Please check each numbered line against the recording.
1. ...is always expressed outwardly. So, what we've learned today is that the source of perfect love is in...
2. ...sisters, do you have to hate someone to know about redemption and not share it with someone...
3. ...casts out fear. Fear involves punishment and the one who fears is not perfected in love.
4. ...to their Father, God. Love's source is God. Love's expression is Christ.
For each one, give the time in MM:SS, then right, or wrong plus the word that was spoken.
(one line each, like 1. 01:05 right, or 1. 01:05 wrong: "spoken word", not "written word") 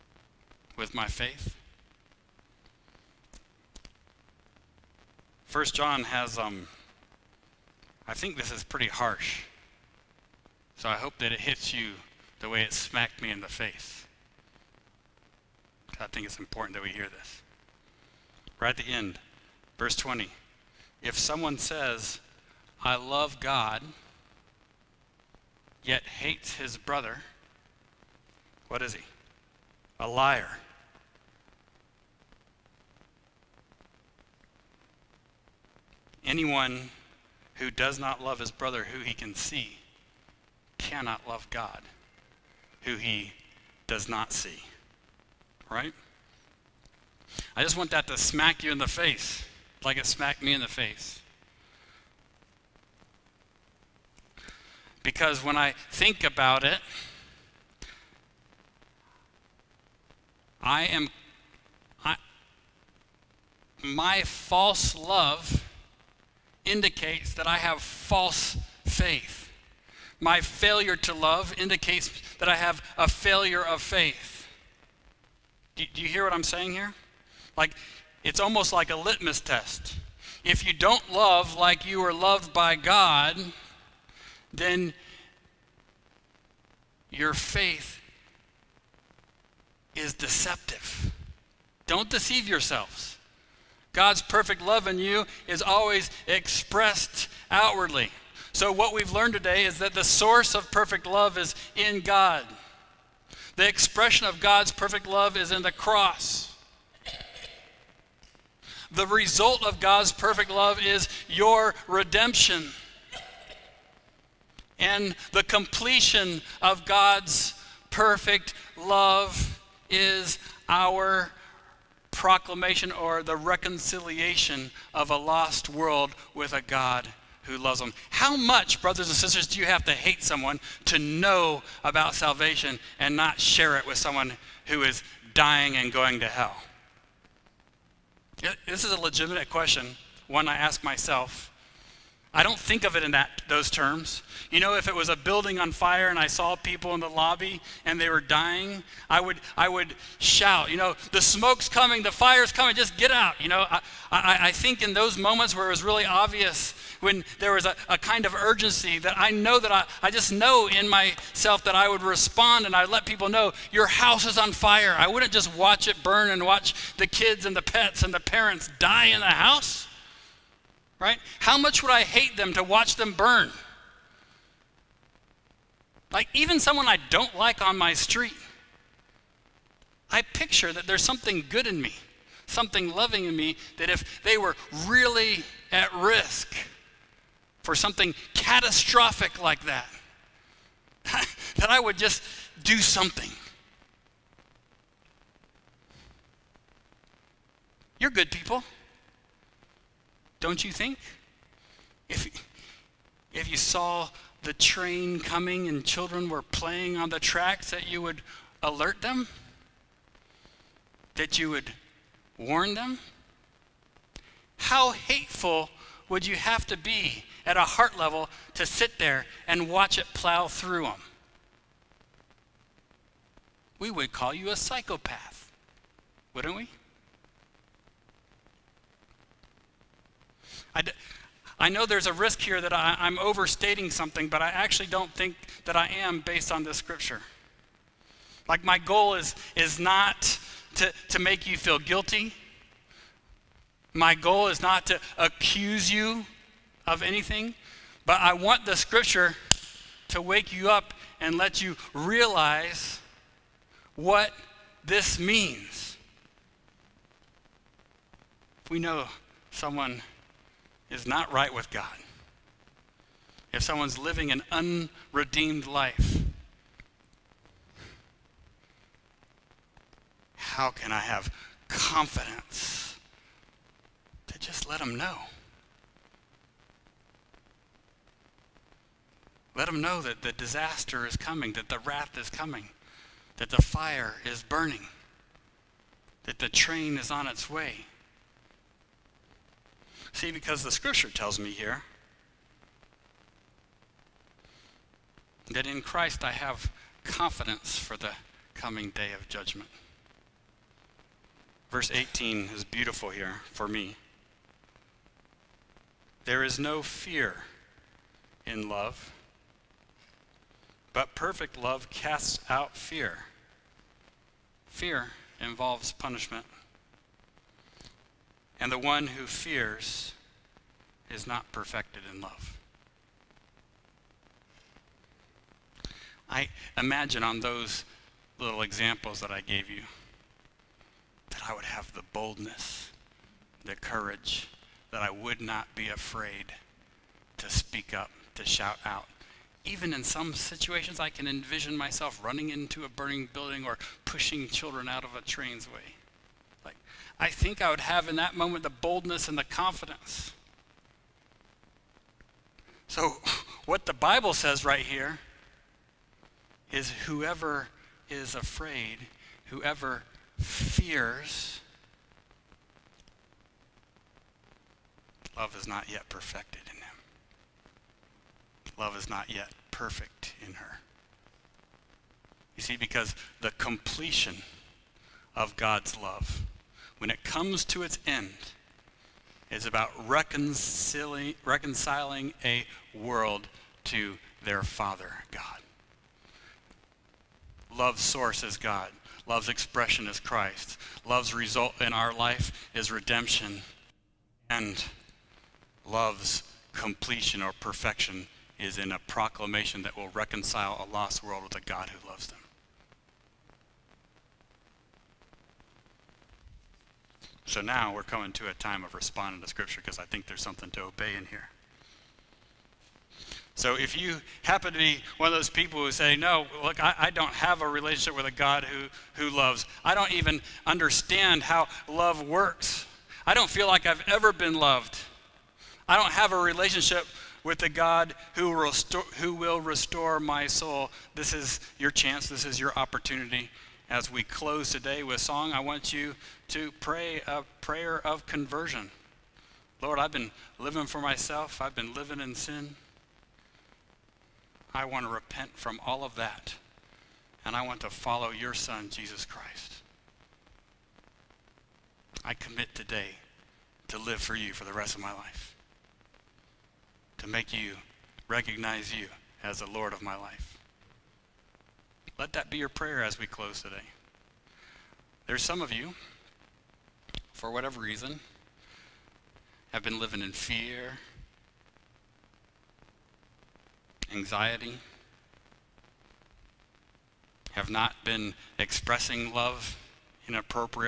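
1. 01:35 right
2. 02:09 wrong: "salvation", not "redemption"
3. 05:11 right
4. 06:23 right.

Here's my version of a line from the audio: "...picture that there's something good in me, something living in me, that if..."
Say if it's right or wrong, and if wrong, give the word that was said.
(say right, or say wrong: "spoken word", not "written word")
wrong: "loving", not "living".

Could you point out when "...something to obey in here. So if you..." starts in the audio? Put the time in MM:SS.
06:50.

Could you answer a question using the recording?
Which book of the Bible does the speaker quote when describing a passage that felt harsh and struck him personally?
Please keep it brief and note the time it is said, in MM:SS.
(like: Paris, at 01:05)
First John, at 00:05.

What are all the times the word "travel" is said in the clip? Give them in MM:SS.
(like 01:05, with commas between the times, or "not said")
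not said.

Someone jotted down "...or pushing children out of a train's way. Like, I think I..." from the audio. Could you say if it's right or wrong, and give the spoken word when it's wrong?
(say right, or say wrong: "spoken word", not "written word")
right.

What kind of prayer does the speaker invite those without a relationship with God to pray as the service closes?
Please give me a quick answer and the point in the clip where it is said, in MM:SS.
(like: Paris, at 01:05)
Prayer of conversion, at 07:17.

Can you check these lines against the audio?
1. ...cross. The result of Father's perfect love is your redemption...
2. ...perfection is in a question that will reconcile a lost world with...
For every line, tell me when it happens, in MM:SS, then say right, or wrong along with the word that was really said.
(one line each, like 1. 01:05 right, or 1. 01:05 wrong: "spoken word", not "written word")
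1. 01:45 wrong: "God", not "Father"
2. 06:37 wrong: "proclamation", not "question".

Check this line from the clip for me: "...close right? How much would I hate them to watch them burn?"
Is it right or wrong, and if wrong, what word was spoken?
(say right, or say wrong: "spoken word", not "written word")
wrong: "house", not "close".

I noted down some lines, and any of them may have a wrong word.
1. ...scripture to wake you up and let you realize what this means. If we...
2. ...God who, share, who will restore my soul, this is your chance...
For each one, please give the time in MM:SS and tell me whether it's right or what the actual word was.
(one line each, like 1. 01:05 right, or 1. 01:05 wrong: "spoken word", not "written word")
1. 04:08 right
2. 07:07 wrong: "restore", not "share".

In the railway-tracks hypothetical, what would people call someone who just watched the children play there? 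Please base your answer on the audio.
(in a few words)
A psychopath.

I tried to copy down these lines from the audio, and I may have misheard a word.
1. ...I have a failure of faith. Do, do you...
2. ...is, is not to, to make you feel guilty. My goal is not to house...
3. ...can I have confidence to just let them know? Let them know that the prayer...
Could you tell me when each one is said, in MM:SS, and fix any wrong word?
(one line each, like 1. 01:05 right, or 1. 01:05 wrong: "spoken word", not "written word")
1. 01:12 right
2. 03:59 wrong: "accuse", not "house"
3. 04:30 wrong: "disaster", not "prayer".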